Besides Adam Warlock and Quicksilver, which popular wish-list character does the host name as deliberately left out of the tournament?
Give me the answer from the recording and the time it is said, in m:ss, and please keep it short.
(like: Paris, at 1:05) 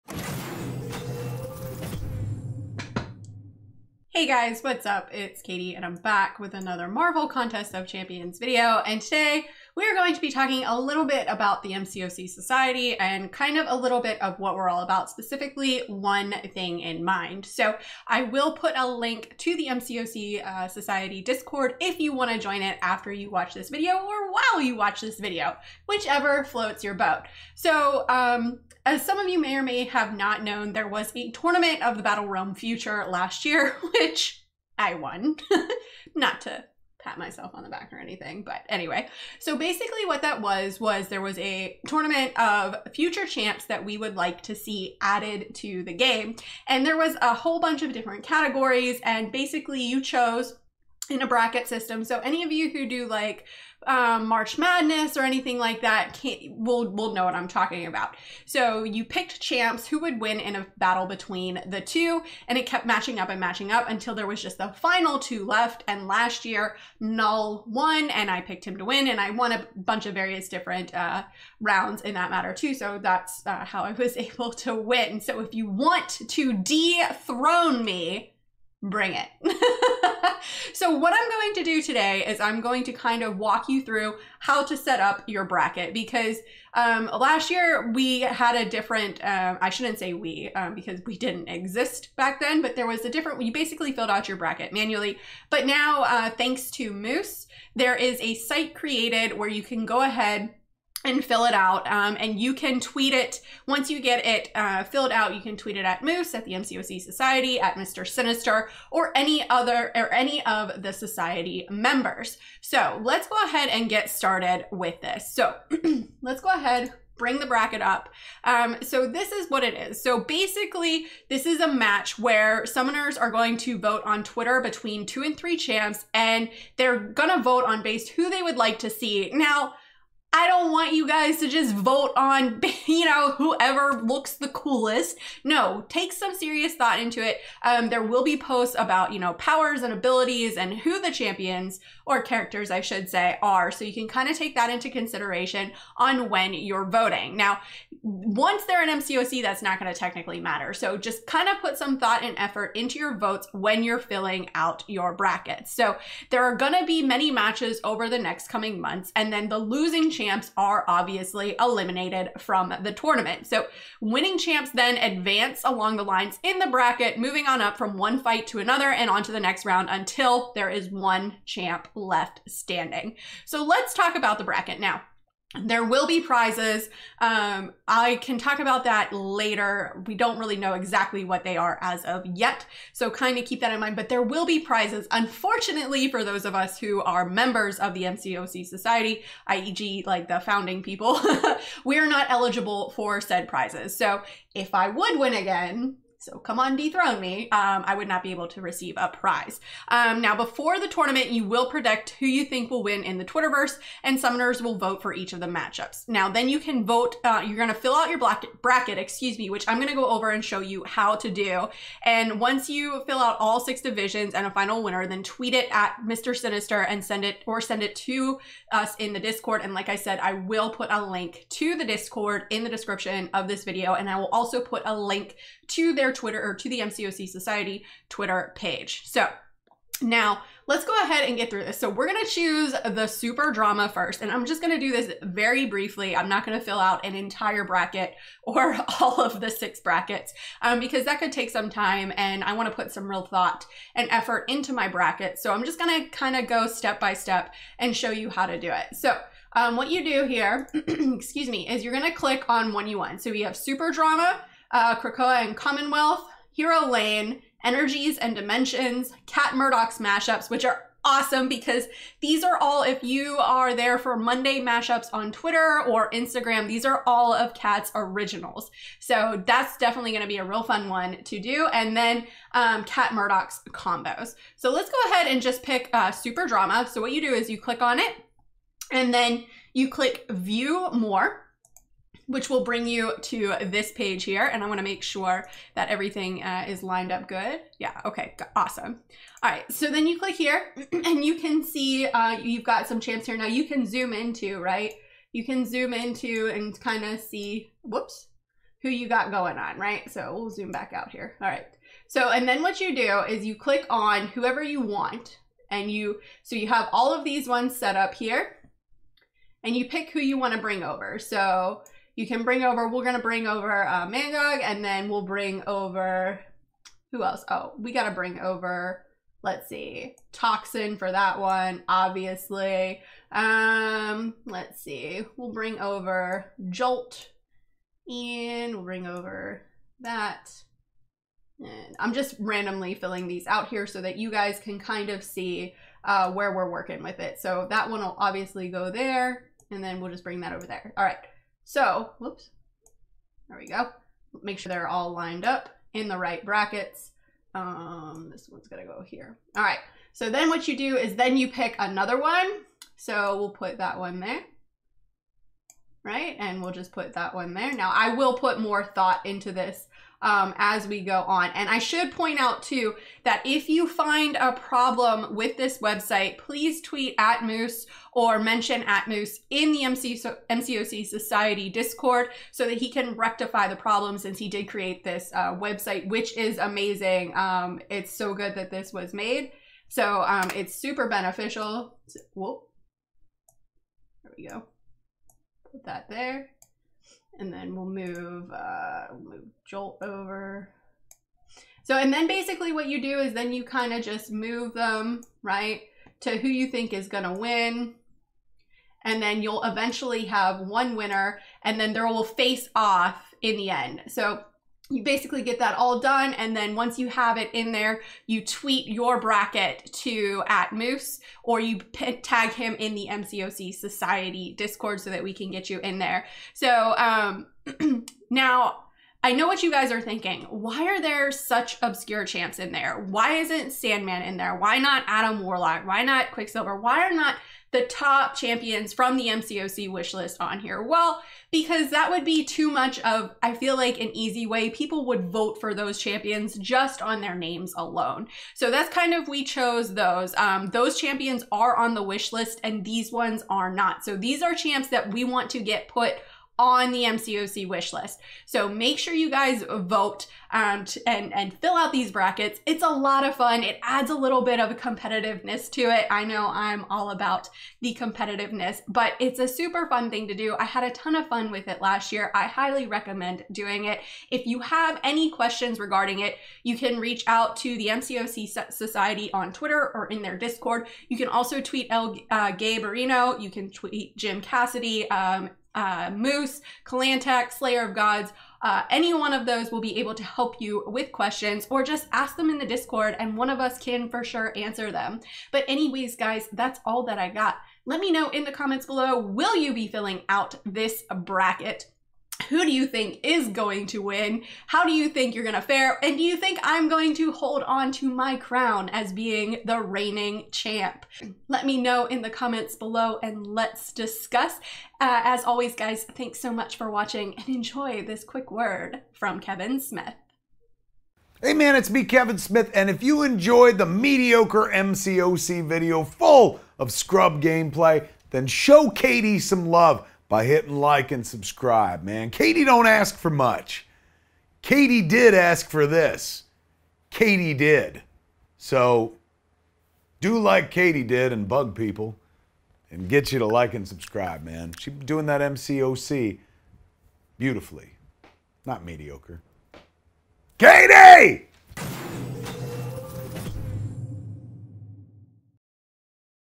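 Sandman, at 7:03.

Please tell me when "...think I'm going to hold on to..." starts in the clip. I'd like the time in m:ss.
8:16.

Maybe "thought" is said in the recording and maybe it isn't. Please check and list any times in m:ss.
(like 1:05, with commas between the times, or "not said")
2:16, 2:31, 4:03, 5:58.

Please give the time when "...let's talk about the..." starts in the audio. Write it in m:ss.
2:53.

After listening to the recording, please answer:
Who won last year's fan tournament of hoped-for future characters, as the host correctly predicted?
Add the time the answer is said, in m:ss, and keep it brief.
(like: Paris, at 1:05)
Null, at 1:06.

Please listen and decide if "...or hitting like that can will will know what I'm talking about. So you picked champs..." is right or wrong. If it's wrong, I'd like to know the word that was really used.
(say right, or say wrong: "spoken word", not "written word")
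wrong: "anything", not "hitting".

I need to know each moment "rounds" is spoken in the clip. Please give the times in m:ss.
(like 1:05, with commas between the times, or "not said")
1:11, 2:49.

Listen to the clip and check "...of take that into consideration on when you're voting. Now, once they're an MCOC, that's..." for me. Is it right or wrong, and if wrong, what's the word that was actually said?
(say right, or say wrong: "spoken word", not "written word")
right.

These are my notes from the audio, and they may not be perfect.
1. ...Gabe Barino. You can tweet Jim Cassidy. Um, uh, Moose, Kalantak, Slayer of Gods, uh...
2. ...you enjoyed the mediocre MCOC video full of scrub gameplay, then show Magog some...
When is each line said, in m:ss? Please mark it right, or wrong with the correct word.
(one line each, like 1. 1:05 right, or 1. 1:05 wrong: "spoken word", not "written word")
1. 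7:52 right
2. 8:33 wrong: "Katy", not "Magog".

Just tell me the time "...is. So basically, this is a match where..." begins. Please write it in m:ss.
1:59.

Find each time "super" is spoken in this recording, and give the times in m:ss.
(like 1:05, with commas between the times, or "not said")
3:53, 4:13, 4:36, 6:20, 7:39.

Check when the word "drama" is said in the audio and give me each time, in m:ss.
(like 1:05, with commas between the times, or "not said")
3:53, 4:13, 4:36.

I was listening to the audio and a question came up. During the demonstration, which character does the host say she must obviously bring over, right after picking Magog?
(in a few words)
Toxin.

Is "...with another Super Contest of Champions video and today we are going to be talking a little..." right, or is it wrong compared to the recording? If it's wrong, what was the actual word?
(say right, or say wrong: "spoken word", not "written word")
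wrong: "Marvel", not "Super".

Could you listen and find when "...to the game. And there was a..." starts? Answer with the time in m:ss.
0:45.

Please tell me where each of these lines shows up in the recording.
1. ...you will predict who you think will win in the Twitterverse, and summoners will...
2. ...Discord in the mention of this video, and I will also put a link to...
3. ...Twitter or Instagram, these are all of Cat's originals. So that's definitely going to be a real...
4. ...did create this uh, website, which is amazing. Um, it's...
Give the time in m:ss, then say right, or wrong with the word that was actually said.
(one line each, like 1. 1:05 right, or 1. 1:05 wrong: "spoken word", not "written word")
1. 3:21 right
2. 3:41 wrong: "description", not "mention"
3. 4:25 right
4. 6:14 right.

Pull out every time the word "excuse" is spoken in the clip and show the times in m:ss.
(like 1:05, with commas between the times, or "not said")
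3:28, 4:10.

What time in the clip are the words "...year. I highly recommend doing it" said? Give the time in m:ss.
7:42.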